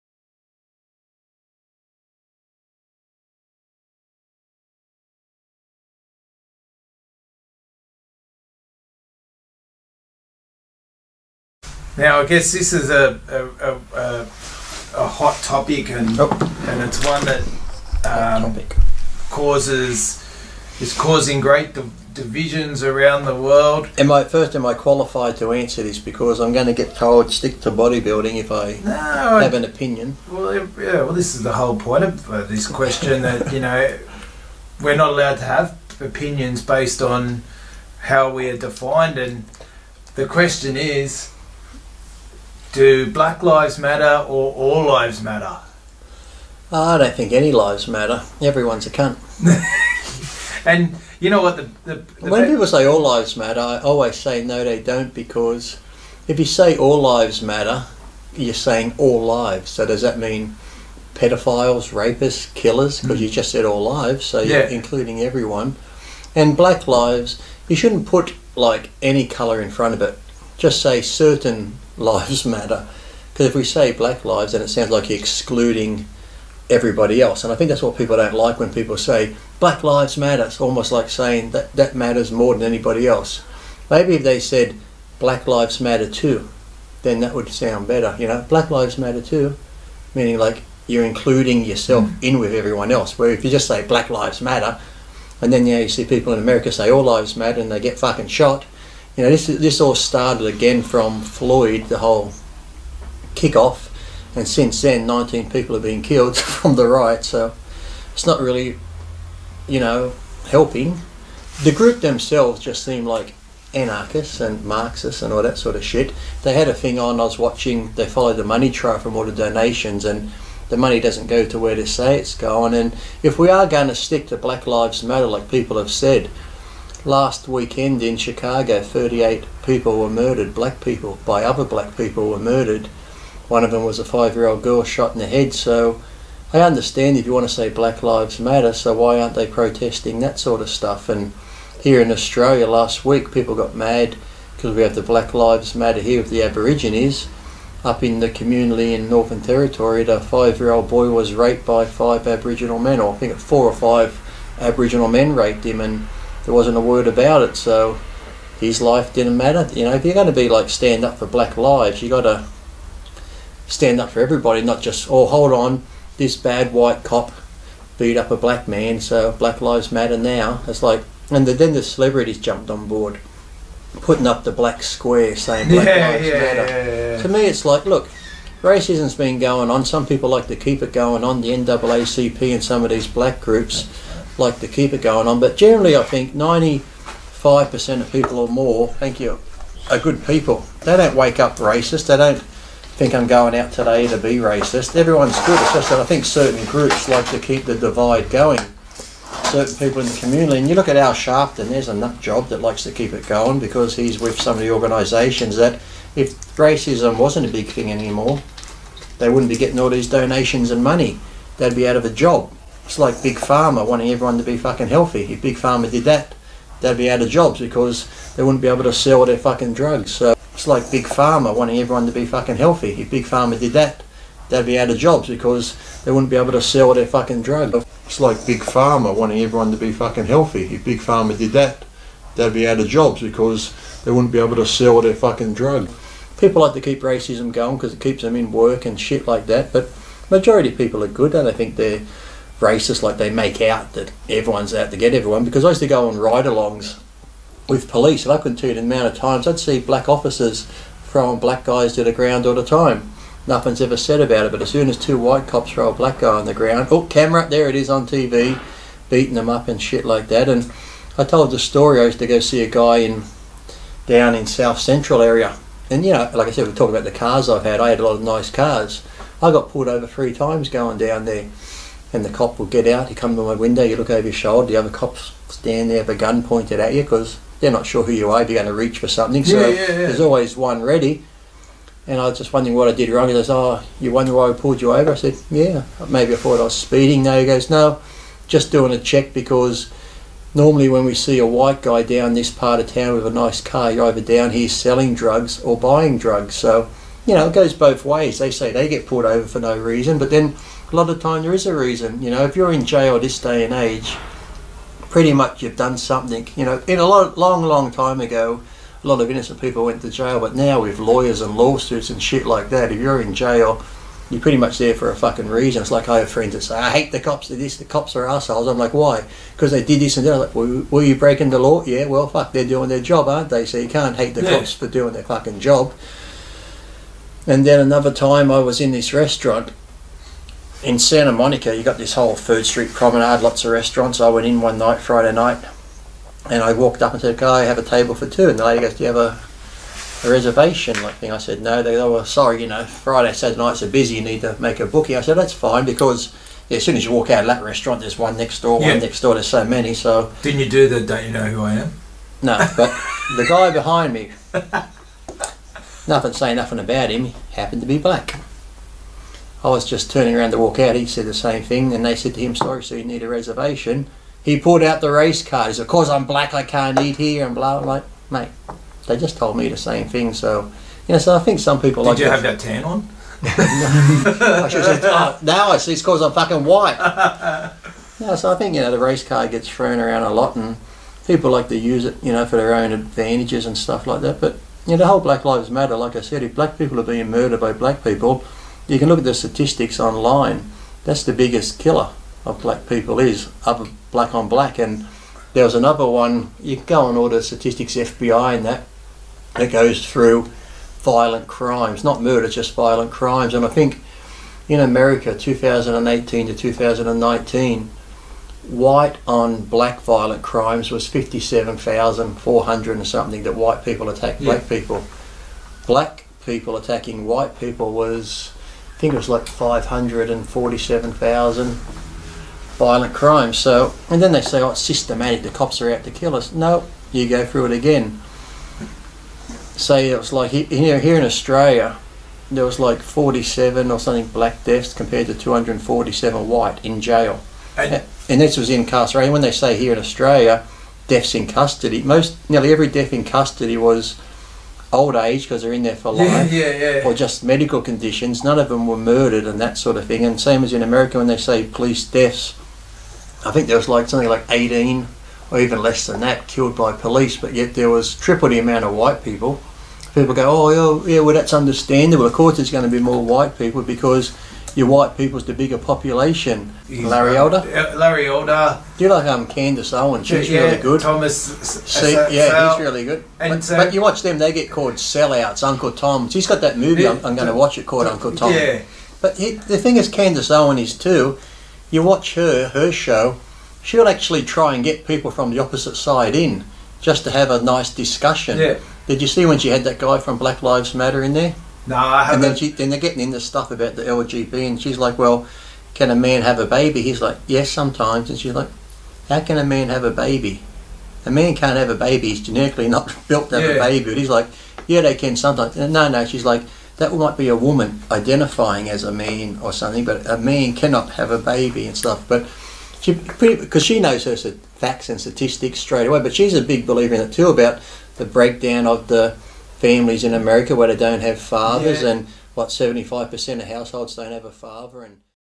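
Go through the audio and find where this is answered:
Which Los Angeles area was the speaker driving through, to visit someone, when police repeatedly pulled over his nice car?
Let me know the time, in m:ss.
4:24.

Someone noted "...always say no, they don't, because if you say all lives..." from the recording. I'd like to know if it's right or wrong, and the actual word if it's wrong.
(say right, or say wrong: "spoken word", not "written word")
right.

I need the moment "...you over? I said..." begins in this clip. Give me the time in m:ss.
4:44.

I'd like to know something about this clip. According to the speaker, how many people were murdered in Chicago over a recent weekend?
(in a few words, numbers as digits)
38.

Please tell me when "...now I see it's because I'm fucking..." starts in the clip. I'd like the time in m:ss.
6:15.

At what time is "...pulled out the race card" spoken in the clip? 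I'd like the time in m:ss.
6:04.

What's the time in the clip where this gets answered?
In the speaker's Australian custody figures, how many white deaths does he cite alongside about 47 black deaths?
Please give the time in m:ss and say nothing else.
7:15.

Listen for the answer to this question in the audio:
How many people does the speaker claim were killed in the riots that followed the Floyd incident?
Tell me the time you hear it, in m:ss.
1:45.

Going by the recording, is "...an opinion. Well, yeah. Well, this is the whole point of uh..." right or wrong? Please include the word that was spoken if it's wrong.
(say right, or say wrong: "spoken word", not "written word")
right.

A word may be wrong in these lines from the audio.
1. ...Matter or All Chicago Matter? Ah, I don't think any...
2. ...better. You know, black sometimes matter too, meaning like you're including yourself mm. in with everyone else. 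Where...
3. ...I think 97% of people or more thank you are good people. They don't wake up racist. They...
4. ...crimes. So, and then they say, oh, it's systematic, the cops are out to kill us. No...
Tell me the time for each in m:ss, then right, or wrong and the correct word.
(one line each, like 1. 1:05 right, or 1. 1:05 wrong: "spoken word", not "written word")
1. 0:43 wrong: "Lives", not "Chicago"
2. 1:27 wrong: "lives", not "sometimes"
3. 3:05 wrong: "95", not "97"
4. 7:03 right.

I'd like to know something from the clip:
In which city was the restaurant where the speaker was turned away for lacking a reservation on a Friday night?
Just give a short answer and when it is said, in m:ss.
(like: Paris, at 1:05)
Santa Monica, at 5:30.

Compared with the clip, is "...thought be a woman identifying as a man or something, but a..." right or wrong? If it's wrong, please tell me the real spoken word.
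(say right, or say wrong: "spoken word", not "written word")
wrong: "might", not "thought".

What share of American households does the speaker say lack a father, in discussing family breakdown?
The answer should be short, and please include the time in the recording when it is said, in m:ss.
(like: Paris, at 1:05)
75%, at 8:42.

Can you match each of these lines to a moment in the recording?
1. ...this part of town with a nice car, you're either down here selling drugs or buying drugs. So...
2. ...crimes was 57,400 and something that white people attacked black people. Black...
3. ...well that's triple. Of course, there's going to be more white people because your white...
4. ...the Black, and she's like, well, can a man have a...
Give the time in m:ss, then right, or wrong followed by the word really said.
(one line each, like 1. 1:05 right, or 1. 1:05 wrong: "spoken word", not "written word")
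1. 4:52 right
2. 6:50 right
3. 7:41 wrong: "understandable", not "triple"
4. 8:13 wrong: "LGB", not "Black".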